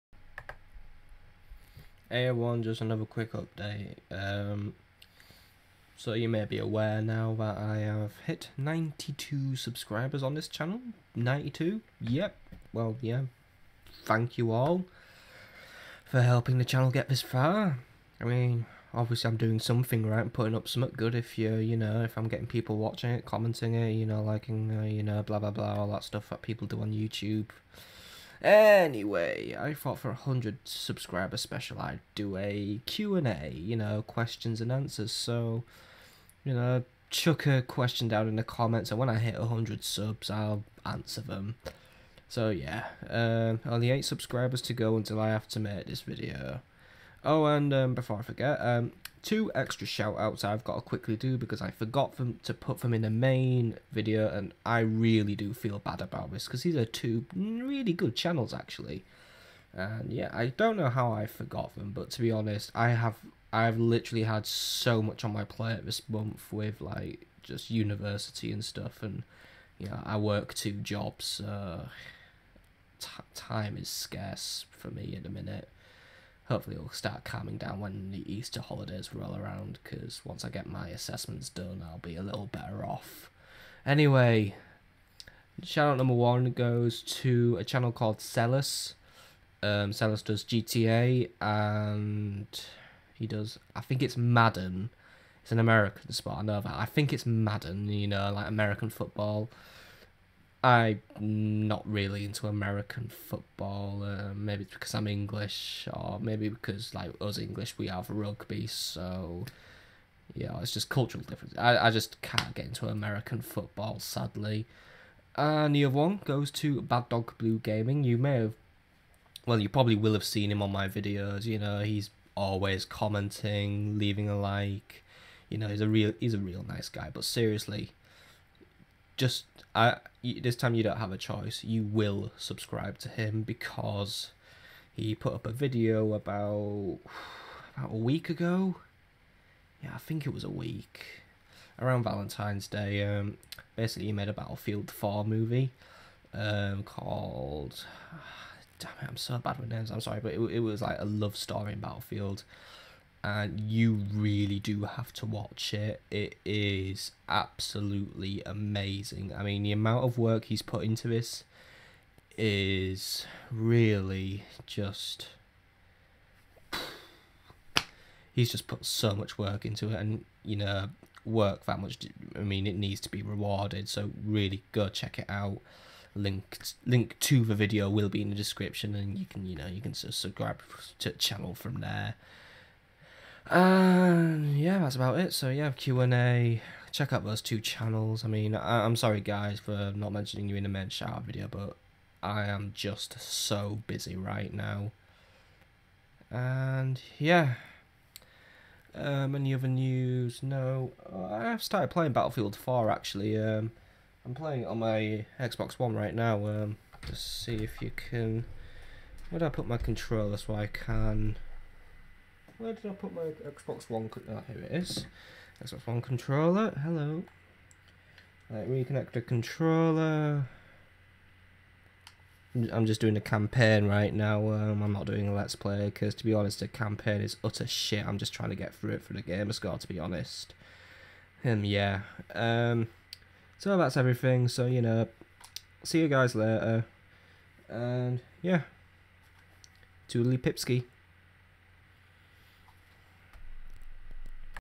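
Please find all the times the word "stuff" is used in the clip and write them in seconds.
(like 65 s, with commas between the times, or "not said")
26 s, 68 s.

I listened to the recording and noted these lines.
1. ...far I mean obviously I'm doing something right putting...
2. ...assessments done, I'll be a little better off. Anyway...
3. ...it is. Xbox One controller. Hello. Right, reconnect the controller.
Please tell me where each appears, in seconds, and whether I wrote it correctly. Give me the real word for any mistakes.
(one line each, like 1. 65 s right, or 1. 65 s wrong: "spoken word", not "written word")
1. 17 s right
2. 80 s right
3. 214 s right.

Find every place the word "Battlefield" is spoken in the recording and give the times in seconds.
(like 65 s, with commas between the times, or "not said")
144 s, 151 s, 202 s.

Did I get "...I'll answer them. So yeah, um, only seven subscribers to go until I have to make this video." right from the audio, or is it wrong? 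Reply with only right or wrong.
wrong.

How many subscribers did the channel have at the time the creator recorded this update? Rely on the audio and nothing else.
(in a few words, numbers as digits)
92.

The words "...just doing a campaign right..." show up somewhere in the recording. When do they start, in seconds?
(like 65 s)
222 s.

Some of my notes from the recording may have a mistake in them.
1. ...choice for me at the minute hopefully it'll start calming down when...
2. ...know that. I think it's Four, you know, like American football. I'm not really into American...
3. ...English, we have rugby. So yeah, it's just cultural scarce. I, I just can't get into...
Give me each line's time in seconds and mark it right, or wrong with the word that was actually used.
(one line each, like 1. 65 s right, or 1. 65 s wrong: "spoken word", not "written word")
1. 73 s wrong: "scarce", not "choice"
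2. 96 s wrong: "Madden", not "Four"
3. 107 s wrong: "difference", not "scarce".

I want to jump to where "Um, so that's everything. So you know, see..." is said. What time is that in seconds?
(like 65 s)
232 s.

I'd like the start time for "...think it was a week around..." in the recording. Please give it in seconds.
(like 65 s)
139 s.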